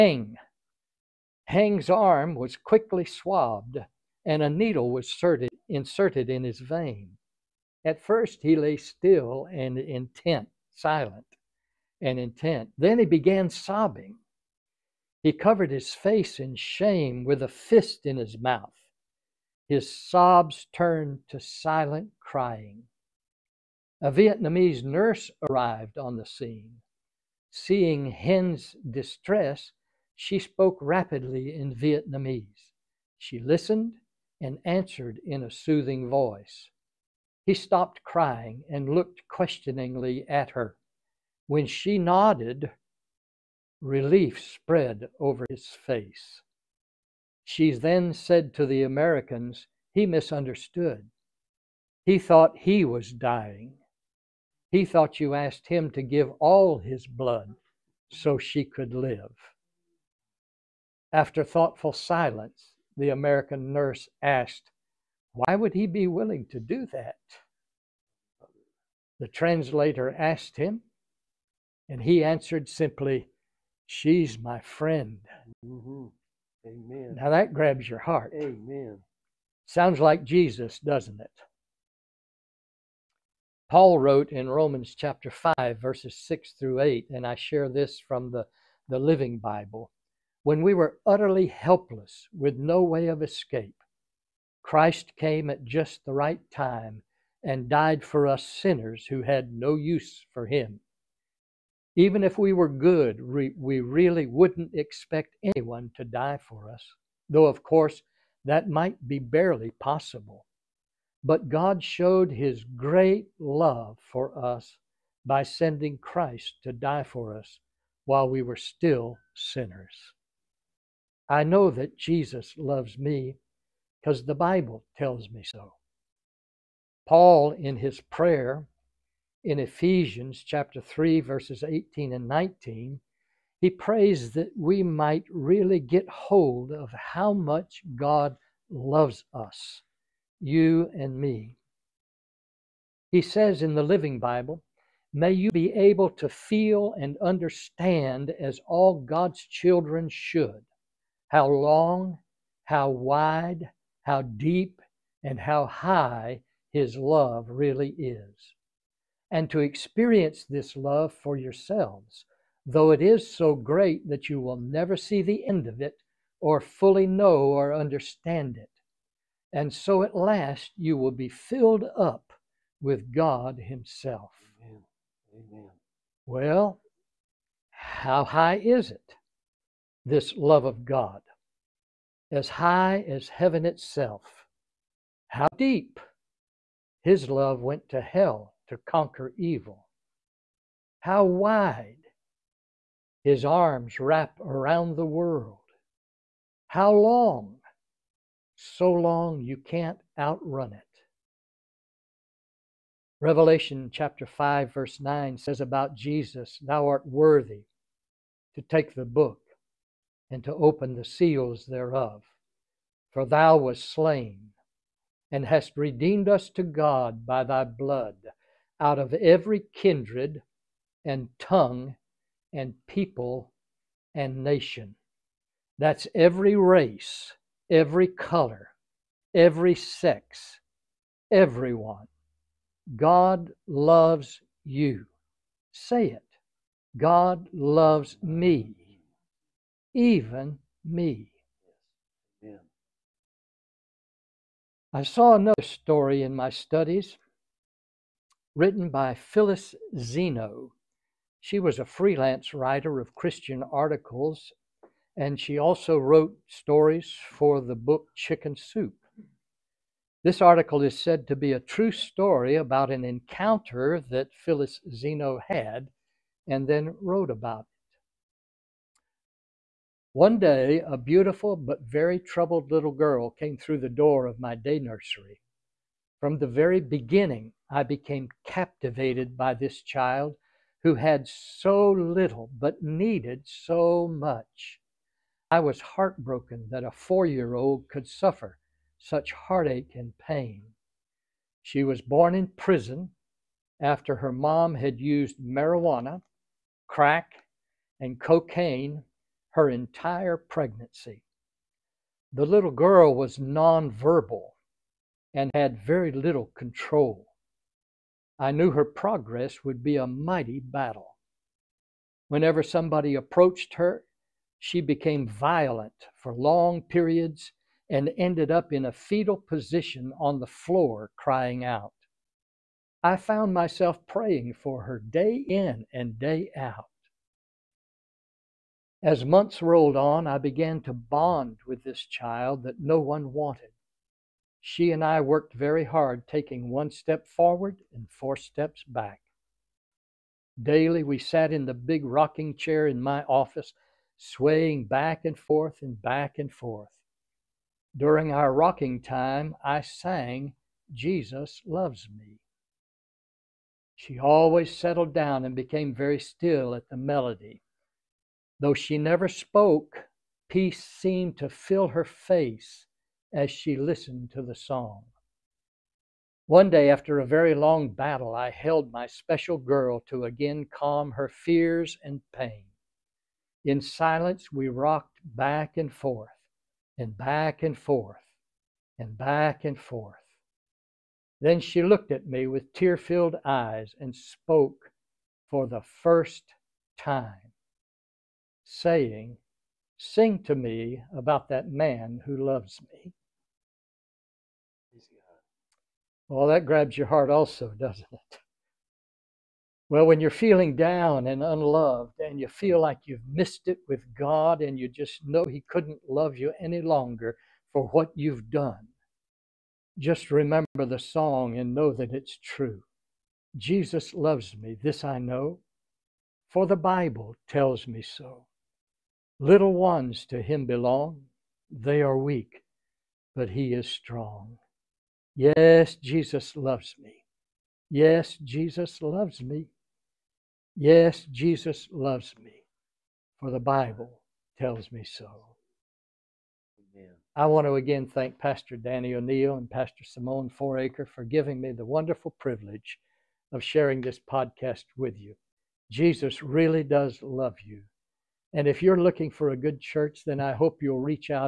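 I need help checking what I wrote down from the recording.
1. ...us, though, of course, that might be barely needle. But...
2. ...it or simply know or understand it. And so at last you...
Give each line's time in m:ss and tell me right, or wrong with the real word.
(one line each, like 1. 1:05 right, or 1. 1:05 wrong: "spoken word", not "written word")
1. 1:46 wrong: "possible", not "needle"
2. 2:45 wrong: "fully", not "simply".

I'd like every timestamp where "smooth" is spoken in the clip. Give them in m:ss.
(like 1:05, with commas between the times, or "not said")
not said.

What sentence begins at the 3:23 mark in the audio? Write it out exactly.
Revelation chapter 5, verse 9 says about Jesus, Thou art worthy to take the book and to open the seals thereof.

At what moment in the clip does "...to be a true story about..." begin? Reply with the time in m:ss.
4:21.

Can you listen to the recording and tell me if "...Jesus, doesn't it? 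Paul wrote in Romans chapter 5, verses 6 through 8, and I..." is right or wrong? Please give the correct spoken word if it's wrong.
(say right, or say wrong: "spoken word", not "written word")
right.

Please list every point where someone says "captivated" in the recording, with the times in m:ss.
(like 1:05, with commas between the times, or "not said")
4:38.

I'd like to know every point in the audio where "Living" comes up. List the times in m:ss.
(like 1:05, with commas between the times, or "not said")
1:28, 2:23.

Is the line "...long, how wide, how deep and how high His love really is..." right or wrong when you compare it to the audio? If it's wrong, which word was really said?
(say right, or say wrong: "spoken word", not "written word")
right.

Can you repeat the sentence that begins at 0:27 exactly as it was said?
Seeing Heng's distress, she spoke rapidly in Vietnamese.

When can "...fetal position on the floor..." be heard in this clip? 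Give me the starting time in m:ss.
5:18.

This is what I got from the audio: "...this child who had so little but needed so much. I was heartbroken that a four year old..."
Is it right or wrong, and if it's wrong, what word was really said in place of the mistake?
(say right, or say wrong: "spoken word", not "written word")
right.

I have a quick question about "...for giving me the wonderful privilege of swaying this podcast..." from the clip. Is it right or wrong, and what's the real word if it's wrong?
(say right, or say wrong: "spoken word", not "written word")
wrong: "sharing", not "swaying".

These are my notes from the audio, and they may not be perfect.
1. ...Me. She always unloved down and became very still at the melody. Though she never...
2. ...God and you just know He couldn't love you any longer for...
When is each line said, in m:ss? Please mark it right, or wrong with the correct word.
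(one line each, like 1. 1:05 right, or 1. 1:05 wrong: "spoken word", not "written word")
1. 5:52 wrong: "settled", not "unloved"
2. 6:44 right.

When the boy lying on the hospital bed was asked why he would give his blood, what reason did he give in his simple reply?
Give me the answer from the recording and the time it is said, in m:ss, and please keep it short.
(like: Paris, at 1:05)
She's my friend, at 1:13.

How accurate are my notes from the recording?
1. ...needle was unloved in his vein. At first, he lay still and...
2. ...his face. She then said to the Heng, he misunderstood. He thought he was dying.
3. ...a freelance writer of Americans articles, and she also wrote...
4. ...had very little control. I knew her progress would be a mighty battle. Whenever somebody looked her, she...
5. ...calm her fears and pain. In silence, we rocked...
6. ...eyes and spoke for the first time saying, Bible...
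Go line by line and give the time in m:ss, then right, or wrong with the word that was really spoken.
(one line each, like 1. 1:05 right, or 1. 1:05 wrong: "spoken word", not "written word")
1. 0:04 wrong: "inserted", not "unloved"
2. 0:45 wrong: "Americans", not "Heng"
3. 4:11 wrong: "Christian", not "Americans"
4. 5:05 wrong: "approached", not "looked"
5. 6:10 right
6. 6:23 wrong: "Sing", not "Bible".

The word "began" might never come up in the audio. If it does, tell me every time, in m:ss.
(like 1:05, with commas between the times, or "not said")
0:13, 5:30.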